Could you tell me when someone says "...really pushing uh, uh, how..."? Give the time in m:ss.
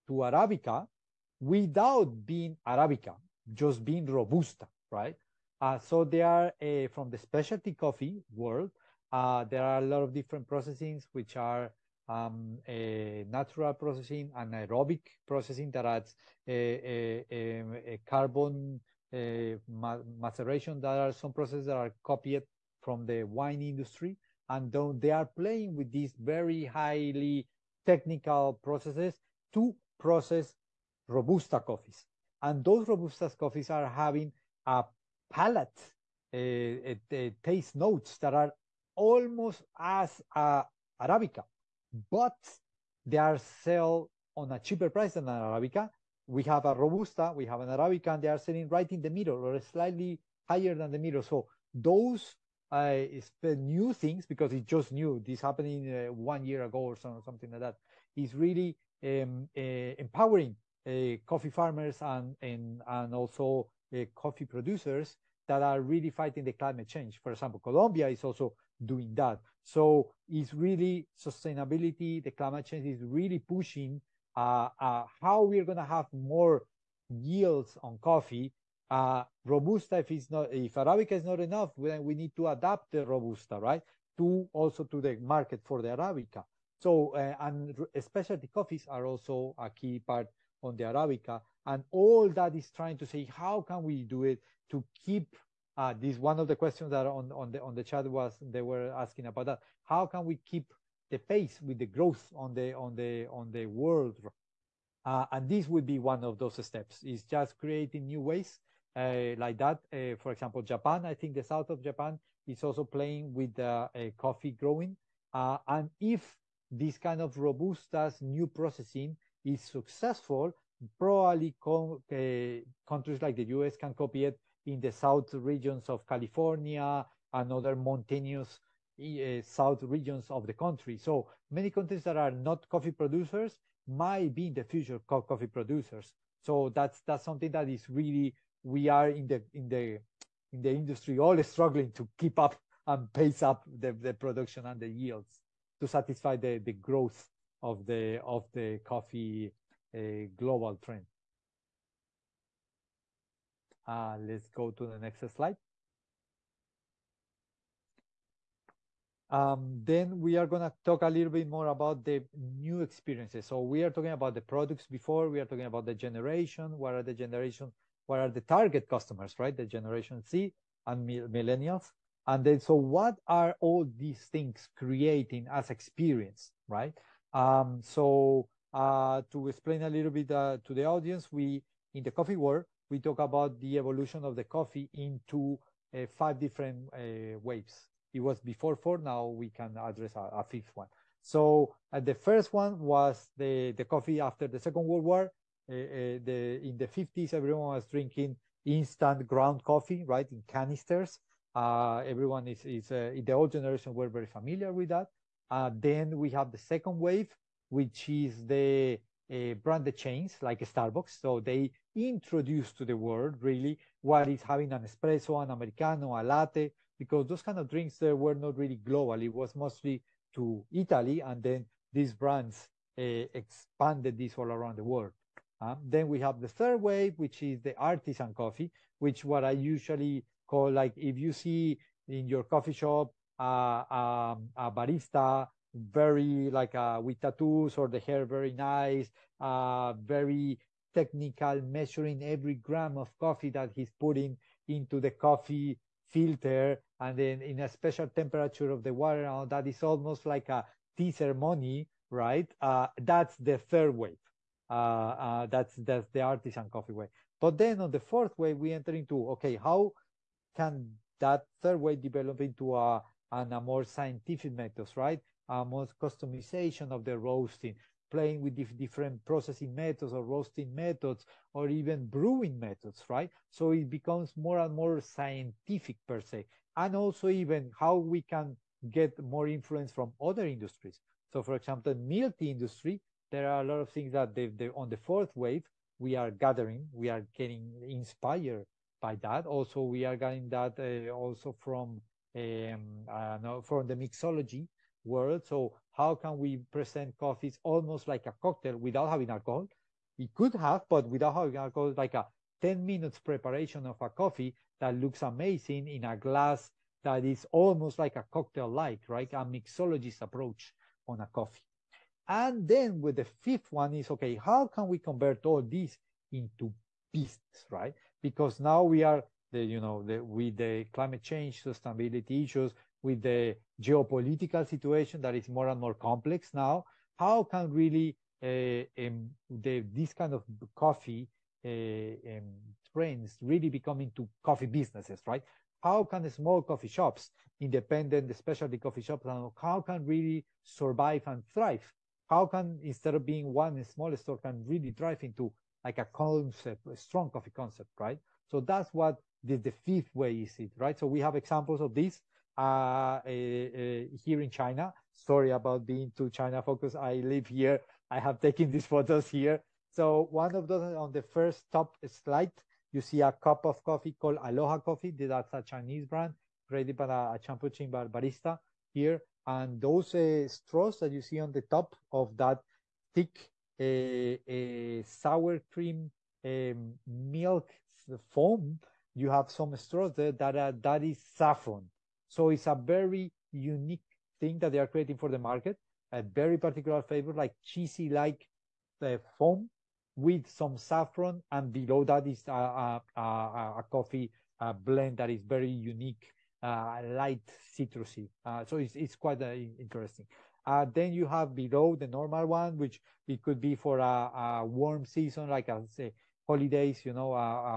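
1:13.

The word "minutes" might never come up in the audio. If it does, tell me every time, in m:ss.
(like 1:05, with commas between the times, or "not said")
5:02.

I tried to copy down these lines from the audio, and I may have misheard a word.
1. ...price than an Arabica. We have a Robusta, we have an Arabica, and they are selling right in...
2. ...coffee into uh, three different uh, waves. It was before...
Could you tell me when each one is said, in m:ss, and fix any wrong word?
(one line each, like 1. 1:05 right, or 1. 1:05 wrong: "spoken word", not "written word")
1. 0:44 right
2. 3:04 wrong: "five", not "three".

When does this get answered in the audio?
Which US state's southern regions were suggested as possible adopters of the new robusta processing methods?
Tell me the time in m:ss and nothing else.
2:06.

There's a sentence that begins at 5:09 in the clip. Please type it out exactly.
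A mixologist approach on a coffee.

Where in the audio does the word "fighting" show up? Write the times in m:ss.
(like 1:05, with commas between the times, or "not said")
1:06.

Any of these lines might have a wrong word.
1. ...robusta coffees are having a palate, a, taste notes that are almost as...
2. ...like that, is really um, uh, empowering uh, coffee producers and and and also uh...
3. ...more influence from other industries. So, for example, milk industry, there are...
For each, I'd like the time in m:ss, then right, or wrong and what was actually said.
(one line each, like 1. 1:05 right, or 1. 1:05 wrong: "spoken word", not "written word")
1. 0:32 right
2. 0:57 wrong: "farmers", not "producers"
3. 4:39 right.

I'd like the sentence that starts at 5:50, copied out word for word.
So we have examples of this uh, uh, uh, here in China.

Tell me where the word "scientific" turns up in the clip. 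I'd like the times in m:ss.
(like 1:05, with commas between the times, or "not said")
4:23, 4:35.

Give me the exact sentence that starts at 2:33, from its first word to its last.
Uh, let's go to the next slide.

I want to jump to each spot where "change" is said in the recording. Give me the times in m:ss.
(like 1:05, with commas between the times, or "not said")
1:06, 1:12, 5:21.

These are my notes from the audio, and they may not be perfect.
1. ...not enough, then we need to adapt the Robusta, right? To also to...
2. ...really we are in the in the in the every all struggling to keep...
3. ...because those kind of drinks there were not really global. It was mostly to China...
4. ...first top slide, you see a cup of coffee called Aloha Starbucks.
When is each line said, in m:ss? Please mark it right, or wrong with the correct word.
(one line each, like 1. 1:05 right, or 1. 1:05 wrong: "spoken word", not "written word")
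1. 1:21 right
2. 2:17 wrong: "industry", not "every"
3. 3:36 wrong: "Italy", not "China"
4. 6:01 wrong: "Coffee", not "Starbucks".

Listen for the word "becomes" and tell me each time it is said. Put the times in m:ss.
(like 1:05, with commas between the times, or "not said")
4:33, 5:33.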